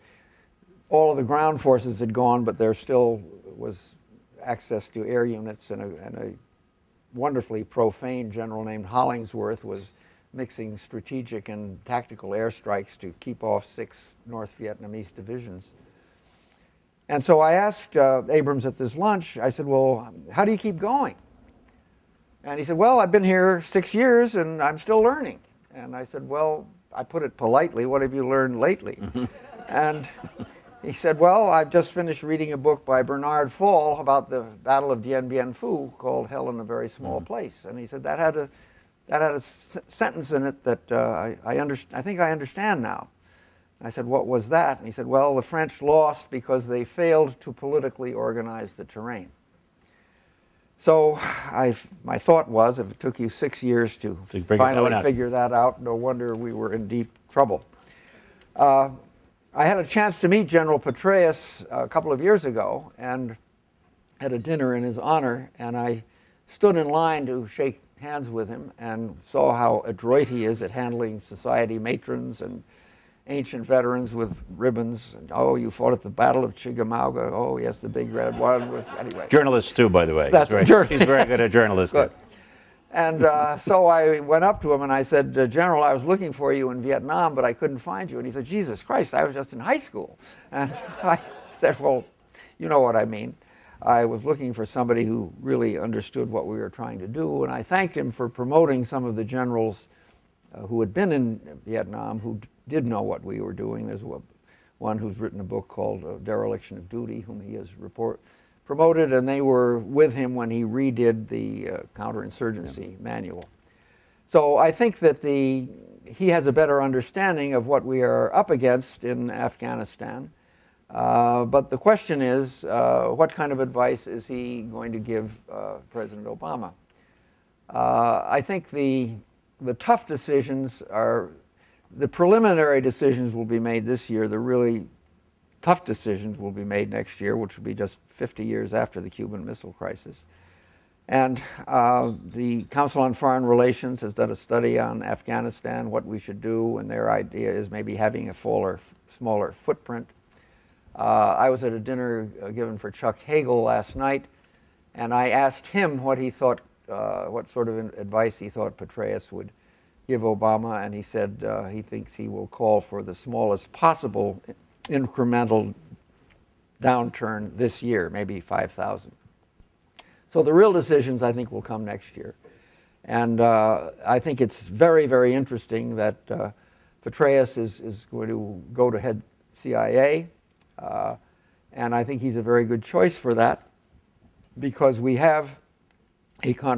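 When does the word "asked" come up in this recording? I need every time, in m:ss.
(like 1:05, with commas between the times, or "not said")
0:17, 2:35.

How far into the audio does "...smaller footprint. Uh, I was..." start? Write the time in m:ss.
2:29.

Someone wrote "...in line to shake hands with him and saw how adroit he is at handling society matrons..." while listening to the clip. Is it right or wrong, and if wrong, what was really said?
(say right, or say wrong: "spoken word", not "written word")
right.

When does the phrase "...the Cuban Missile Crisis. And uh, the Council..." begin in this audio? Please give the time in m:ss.
2:18.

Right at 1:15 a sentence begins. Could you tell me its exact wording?
Oh, you fought at the Battle of Chickamauga.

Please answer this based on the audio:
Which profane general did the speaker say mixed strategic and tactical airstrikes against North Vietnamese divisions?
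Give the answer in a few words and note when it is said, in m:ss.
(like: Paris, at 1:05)
Hollingsworth, at 0:08.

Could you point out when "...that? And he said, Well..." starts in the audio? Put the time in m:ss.
0:44.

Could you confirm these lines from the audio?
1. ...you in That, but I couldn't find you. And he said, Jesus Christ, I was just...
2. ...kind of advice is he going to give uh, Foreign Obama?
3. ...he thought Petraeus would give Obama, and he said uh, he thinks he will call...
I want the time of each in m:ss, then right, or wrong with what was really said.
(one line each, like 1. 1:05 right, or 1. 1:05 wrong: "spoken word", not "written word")
1. 1:26 wrong: "Vietnam", not "That"
2. 2:03 wrong: "President", not "Foreign"
3. 2:38 right.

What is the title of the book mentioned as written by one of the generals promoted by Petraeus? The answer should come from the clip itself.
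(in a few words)
Dereliction of Duty.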